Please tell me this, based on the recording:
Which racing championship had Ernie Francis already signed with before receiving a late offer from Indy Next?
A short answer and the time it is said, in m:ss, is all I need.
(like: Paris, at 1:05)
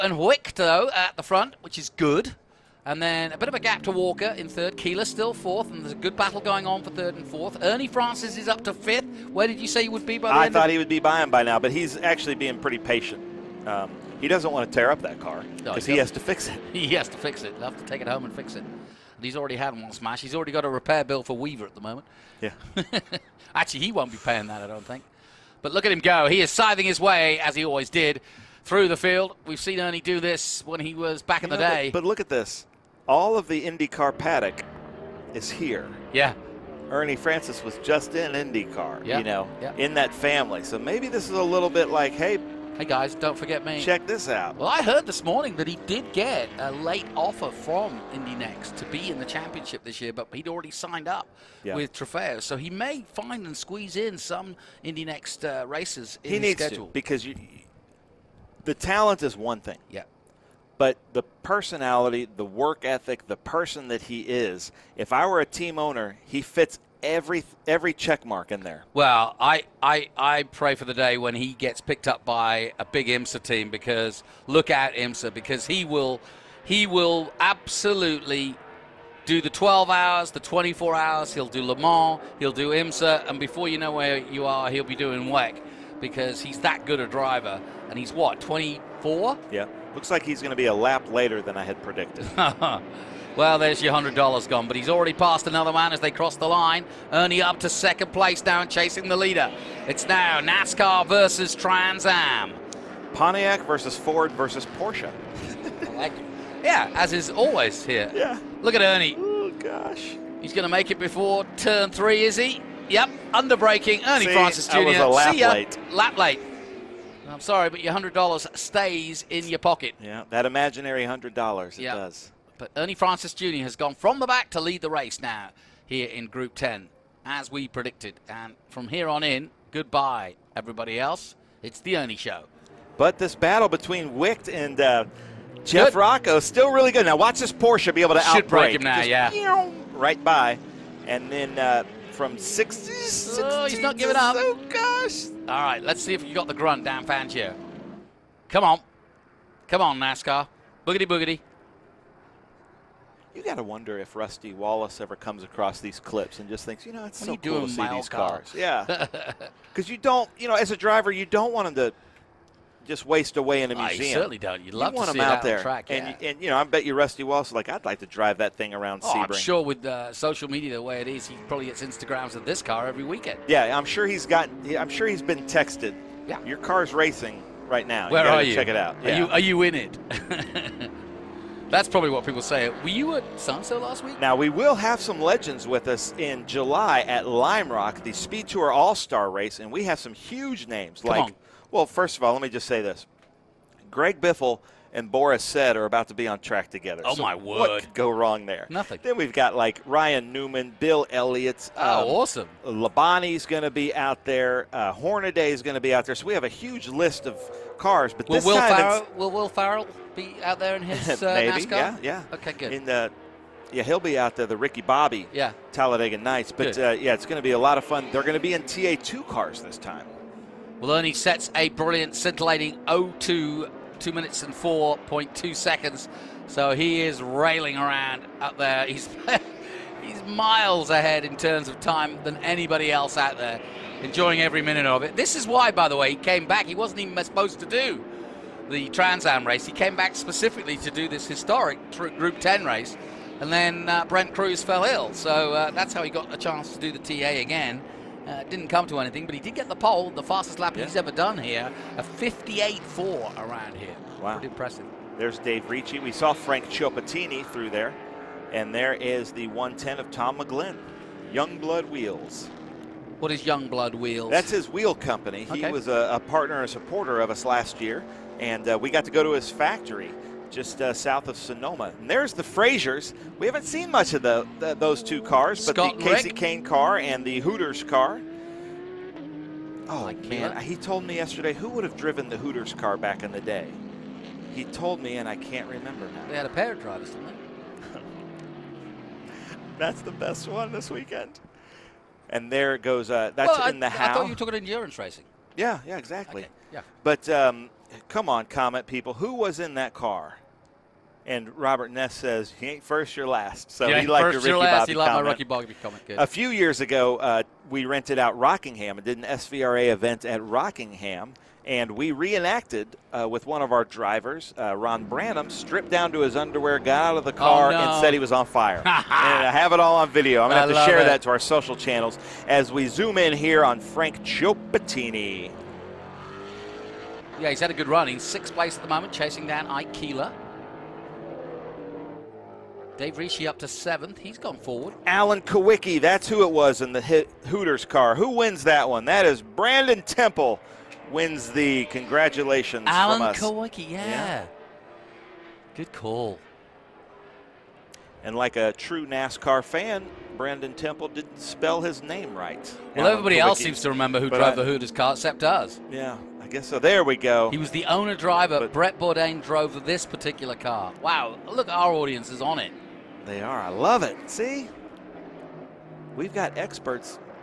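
Trofeo, at 0:51.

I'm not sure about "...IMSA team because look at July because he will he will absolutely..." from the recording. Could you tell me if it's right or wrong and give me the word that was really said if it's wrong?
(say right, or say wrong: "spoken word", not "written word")
wrong: "IMSA", not "July".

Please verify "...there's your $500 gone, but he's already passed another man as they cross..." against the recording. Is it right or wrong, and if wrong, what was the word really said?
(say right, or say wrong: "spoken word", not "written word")
wrong: "100", not "500".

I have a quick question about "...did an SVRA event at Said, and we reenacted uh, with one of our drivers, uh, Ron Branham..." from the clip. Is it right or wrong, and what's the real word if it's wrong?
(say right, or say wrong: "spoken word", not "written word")
wrong: "Rockingham", not "Said".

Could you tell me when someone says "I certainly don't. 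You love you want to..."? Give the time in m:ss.
2:44.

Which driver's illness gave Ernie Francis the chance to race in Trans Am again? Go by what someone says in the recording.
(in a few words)
Brent Crews.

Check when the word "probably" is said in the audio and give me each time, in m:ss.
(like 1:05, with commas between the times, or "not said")
2:51, 3:01.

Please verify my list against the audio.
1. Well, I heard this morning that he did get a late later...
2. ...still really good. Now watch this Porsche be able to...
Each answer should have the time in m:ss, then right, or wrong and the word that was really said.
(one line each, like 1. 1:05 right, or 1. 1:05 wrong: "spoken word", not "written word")
1. 0:44 wrong: "offer", not "later"
2. 2:16 right.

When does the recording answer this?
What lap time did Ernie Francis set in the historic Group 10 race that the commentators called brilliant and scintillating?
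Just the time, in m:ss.
3:44.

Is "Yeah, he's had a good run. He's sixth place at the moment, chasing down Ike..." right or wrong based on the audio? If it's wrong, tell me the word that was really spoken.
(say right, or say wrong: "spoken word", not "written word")
right.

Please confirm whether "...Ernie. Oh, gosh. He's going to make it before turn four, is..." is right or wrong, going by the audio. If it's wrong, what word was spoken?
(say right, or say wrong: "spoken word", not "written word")
wrong: "three", not "four".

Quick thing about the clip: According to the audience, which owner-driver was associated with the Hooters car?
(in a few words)
Alan Kulwicki.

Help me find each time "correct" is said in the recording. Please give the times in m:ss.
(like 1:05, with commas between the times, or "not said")
not said.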